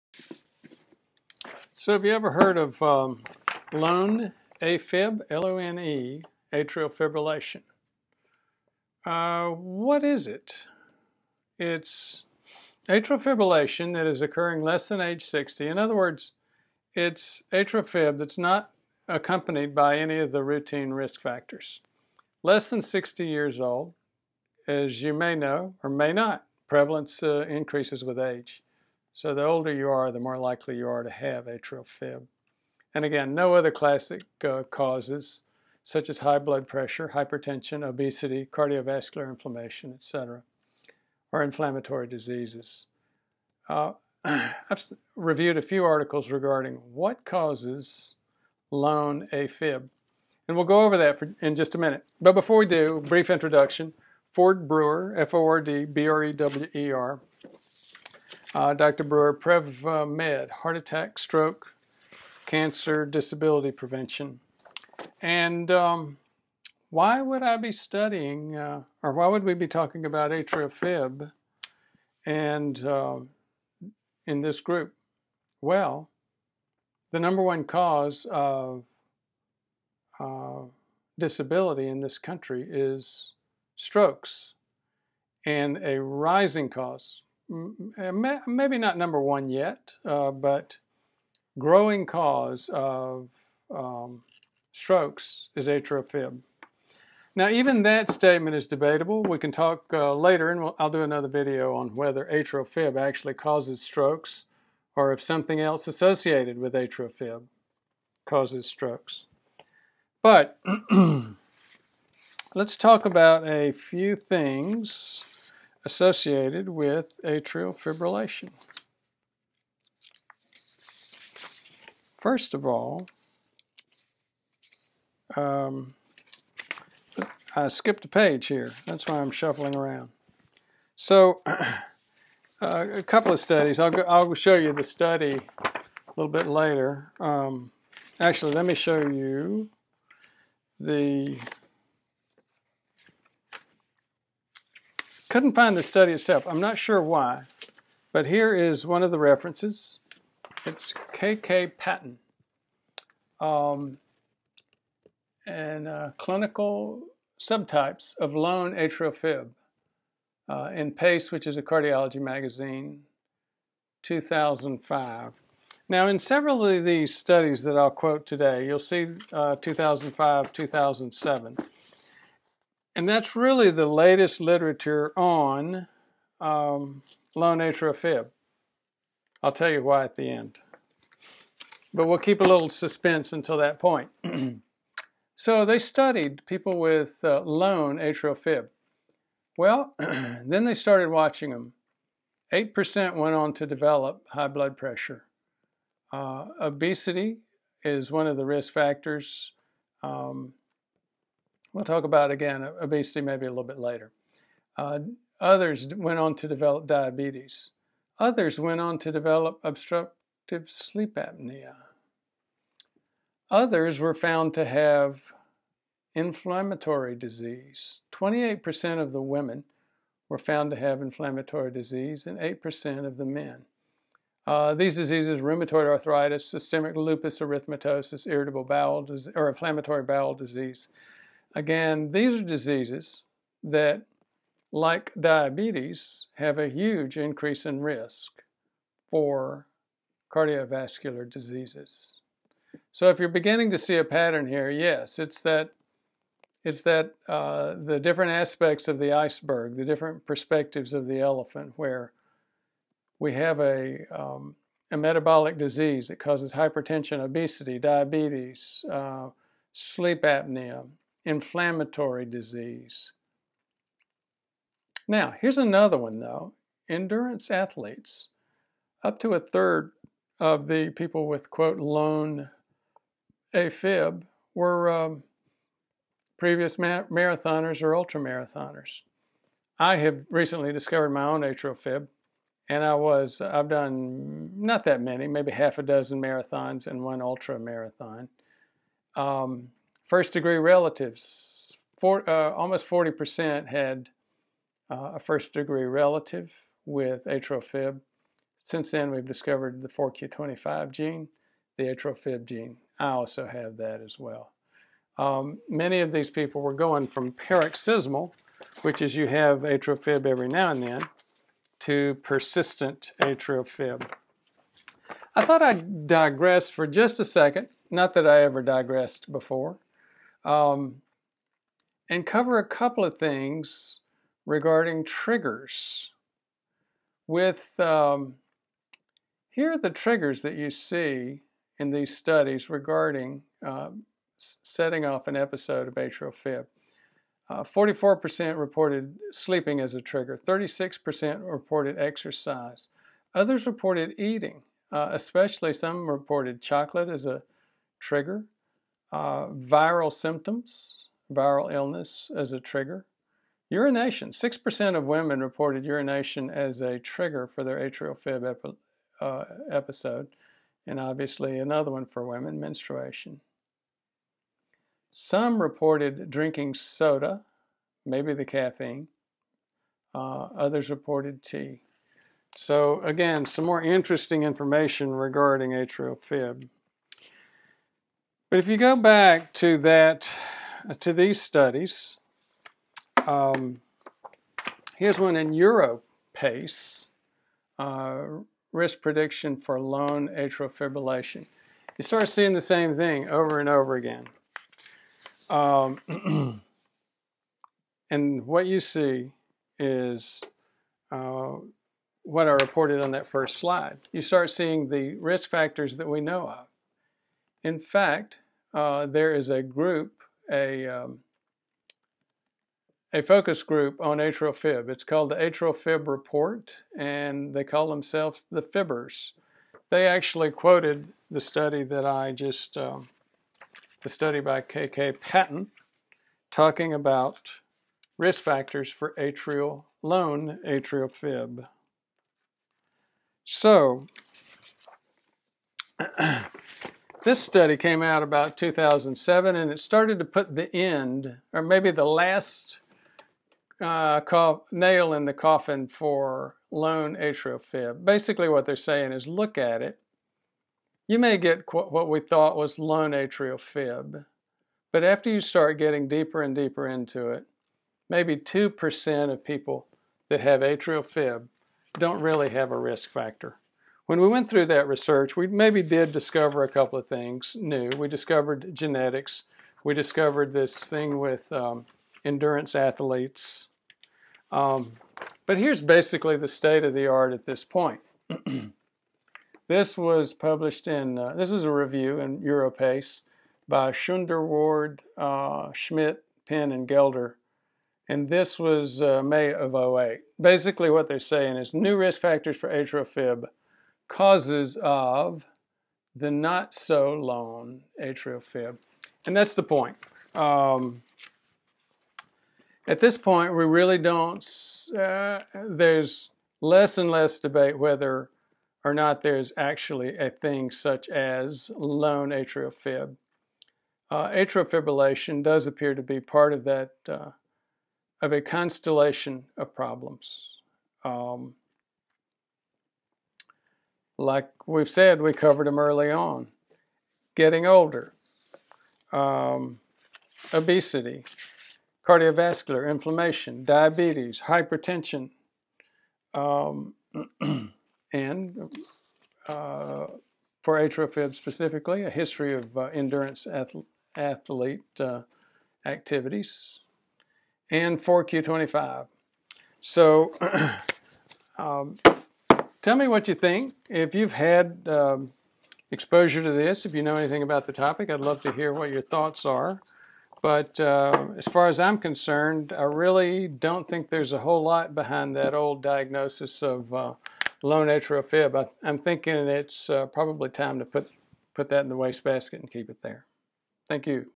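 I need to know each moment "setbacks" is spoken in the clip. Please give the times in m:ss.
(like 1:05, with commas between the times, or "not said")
not said.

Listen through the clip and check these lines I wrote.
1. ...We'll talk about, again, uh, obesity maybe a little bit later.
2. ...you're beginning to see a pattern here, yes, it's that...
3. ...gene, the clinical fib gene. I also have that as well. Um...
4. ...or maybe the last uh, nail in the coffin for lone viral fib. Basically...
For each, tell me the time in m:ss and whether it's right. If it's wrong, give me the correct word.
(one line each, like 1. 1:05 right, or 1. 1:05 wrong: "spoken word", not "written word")
1. 3:21 right
2. 4:03 right
3. 5:00 wrong: "atrial", not "clinical"
4. 7:21 wrong: "atrial", not "viral".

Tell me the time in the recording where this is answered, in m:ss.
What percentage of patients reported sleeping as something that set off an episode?
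5:37.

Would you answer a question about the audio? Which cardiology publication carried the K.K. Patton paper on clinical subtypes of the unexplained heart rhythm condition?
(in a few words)
PACE.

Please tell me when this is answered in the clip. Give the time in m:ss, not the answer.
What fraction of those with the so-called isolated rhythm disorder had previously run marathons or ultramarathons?
4:29.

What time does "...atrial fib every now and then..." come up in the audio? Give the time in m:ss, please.
5:09.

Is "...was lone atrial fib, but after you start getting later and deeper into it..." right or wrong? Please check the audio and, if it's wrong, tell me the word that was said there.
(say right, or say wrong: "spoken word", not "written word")
wrong: "deeper", not "later".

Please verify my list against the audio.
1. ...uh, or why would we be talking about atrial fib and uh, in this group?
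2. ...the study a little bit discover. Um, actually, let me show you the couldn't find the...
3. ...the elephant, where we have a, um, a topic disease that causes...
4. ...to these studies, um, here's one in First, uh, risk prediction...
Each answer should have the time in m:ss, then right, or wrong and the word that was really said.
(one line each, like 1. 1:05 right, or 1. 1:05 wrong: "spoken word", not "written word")
1. 1:08 right
2. 2:14 wrong: "later", not "discover"
3. 4:11 wrong: "metabolic", not "topic"
4. 6:20 wrong: "Europace", not "First".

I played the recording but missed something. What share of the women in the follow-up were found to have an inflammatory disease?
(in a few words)
28%.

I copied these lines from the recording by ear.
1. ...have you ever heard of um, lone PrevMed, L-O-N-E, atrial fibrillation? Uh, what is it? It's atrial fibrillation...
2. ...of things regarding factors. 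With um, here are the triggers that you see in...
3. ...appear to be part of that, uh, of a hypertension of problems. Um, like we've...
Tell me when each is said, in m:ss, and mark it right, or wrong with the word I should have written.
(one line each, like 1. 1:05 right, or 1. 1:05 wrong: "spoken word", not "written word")
1. 0:01 wrong: "AFib", not "PrevMed"
2. 5:23 wrong: "triggers", not "factors"
3. 8:35 wrong: "constellation", not "hypertension".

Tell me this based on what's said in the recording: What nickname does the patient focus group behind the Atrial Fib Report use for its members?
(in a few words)
the Fibbers.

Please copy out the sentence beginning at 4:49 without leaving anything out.
Um, First degree relatives, uh, almost 40% had uh, a first degree relative with atrial fib.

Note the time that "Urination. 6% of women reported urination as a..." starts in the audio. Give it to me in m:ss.
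5:53.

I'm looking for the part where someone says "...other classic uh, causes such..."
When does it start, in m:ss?
0:33.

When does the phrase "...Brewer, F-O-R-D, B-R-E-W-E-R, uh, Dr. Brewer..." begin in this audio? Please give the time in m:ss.
0:54.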